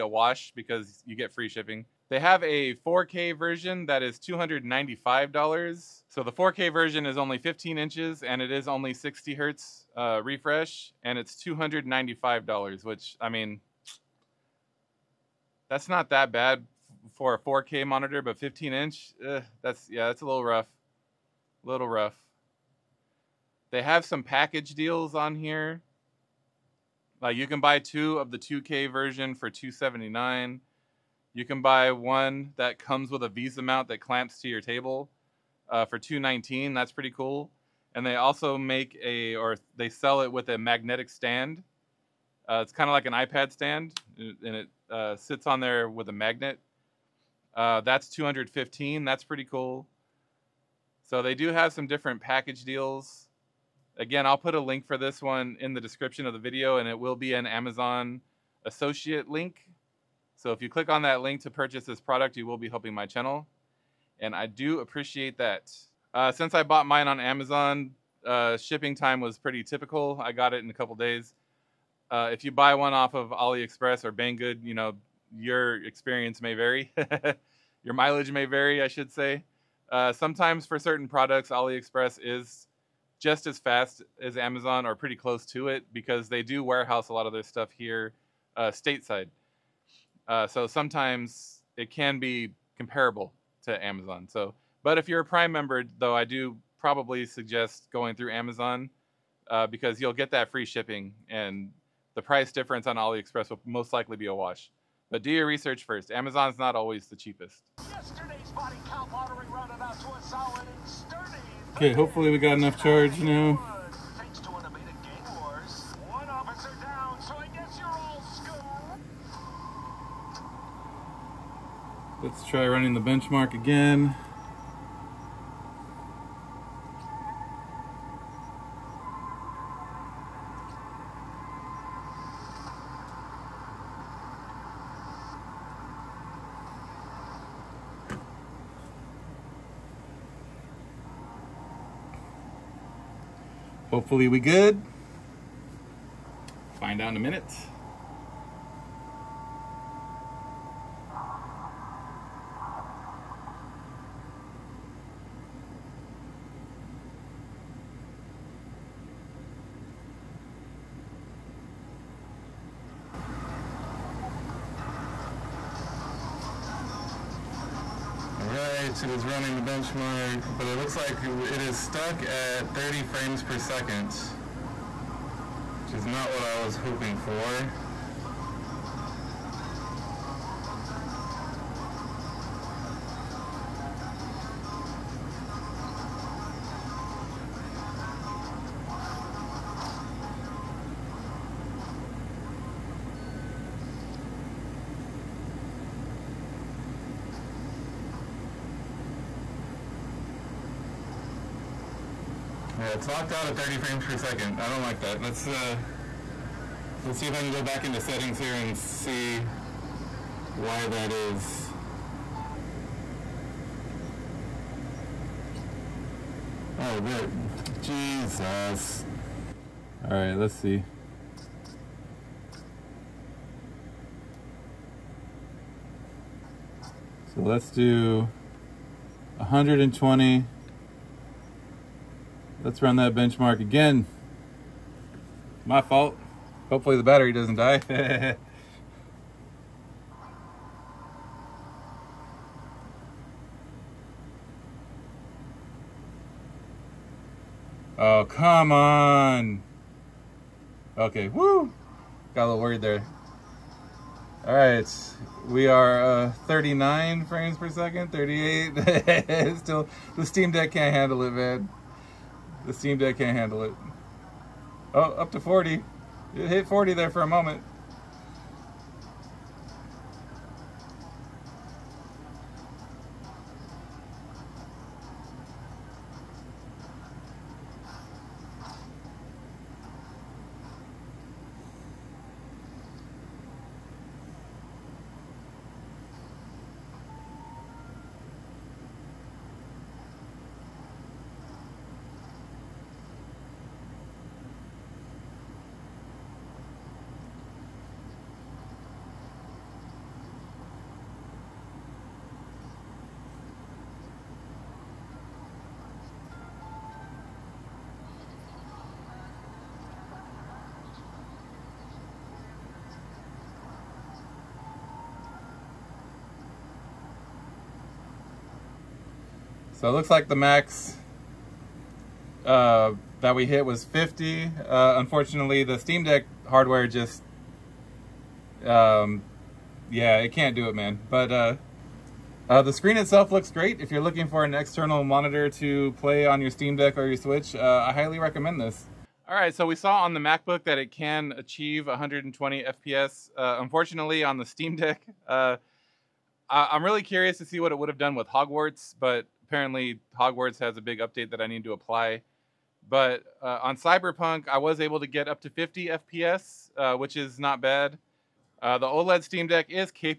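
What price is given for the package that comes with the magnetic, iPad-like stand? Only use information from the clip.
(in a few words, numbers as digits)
215.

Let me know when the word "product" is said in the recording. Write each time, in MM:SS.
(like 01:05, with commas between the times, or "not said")
01:01, 01:21.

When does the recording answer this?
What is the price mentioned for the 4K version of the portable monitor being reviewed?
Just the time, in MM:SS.
00:04.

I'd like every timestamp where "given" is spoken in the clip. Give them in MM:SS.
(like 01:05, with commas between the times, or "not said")
not said.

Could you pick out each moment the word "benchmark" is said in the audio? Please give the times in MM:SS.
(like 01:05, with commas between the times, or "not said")
02:02, 02:49, 03:53.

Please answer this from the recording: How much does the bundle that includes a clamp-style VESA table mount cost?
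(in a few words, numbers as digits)
219.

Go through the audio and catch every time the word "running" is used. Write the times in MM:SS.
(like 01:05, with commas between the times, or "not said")
02:02, 02:49.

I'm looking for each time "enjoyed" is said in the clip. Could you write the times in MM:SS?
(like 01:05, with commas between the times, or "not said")
not said.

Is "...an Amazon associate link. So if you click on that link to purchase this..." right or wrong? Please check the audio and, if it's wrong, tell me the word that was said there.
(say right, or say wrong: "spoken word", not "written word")
right.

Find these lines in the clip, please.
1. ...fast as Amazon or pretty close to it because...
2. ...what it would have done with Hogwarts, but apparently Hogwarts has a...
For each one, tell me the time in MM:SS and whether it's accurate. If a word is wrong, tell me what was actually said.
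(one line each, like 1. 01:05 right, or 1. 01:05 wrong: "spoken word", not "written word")
1. 01:23 right
2. 05:47 right.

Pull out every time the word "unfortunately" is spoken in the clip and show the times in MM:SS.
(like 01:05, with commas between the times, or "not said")
05:24, 05:43.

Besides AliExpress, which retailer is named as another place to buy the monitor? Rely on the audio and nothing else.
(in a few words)
Banggood.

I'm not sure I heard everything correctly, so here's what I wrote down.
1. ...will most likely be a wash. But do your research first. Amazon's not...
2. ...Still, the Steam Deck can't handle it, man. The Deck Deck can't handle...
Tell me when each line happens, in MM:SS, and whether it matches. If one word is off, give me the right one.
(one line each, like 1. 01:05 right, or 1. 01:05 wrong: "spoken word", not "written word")
1. 01:43 right
2. 04:19 wrong: "Steam", not "Deck".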